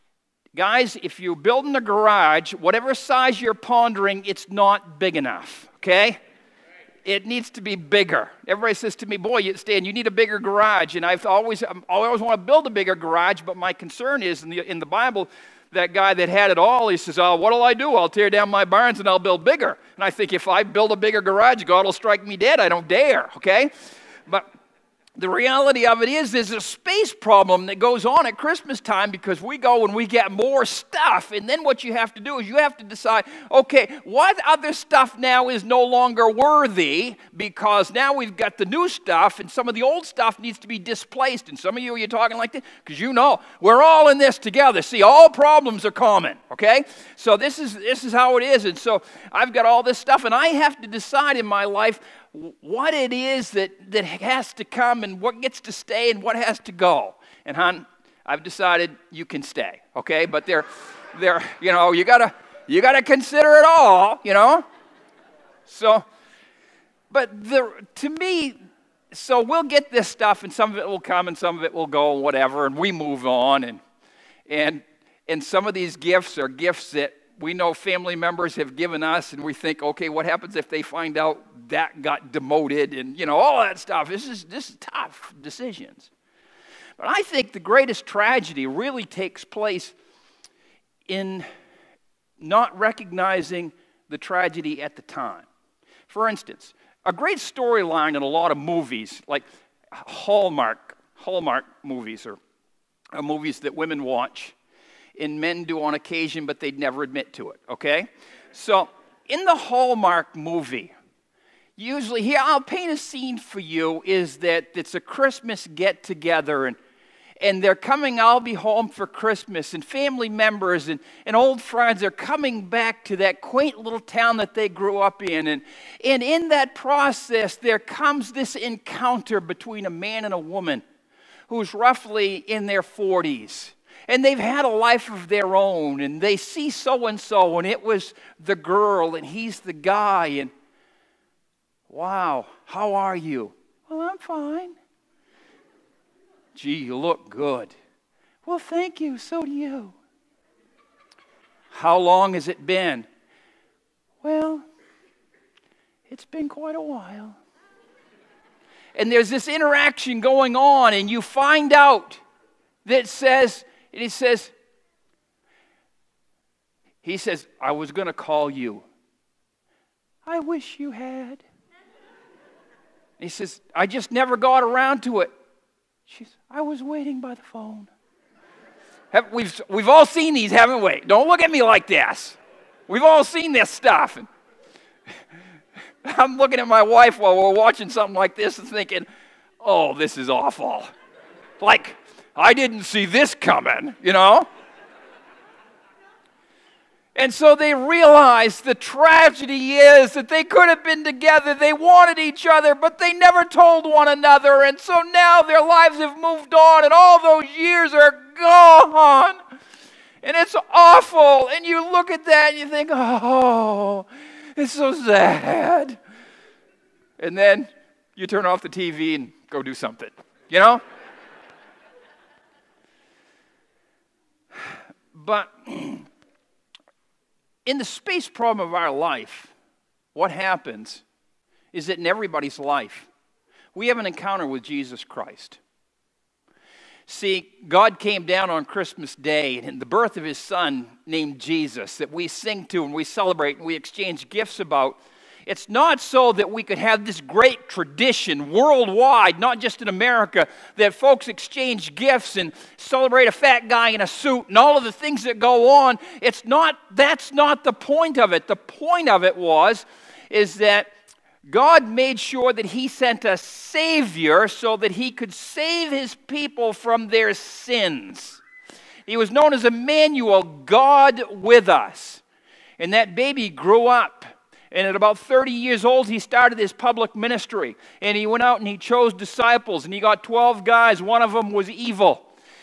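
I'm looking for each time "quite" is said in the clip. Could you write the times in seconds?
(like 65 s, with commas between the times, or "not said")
156 s.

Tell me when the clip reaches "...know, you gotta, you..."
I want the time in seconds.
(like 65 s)
61 s.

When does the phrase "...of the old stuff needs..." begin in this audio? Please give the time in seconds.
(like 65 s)
39 s.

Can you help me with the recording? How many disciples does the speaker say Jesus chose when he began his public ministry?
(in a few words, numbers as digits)
12.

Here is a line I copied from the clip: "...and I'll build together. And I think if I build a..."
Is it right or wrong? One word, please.
wrong.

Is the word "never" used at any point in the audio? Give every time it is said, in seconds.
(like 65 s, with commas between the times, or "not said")
106 s, 174 s, 203 s.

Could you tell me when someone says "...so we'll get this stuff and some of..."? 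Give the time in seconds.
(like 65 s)
69 s.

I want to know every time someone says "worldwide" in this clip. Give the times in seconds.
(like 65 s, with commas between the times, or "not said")
248 s.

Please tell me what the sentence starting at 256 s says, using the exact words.
It's not that's not the point of it.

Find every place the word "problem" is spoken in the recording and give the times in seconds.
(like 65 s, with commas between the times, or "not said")
27 s, 45 s, 228 s.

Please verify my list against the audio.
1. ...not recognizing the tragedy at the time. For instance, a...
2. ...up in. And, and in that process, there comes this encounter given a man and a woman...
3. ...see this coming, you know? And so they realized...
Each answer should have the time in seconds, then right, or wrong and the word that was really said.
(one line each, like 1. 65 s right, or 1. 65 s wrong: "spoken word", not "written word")
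1. 92 s right
2. 124 s wrong: "between", not "given"
3. 192 s right.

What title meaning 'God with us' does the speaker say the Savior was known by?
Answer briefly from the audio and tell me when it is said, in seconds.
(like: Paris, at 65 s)
Emmanuel, at 269 s.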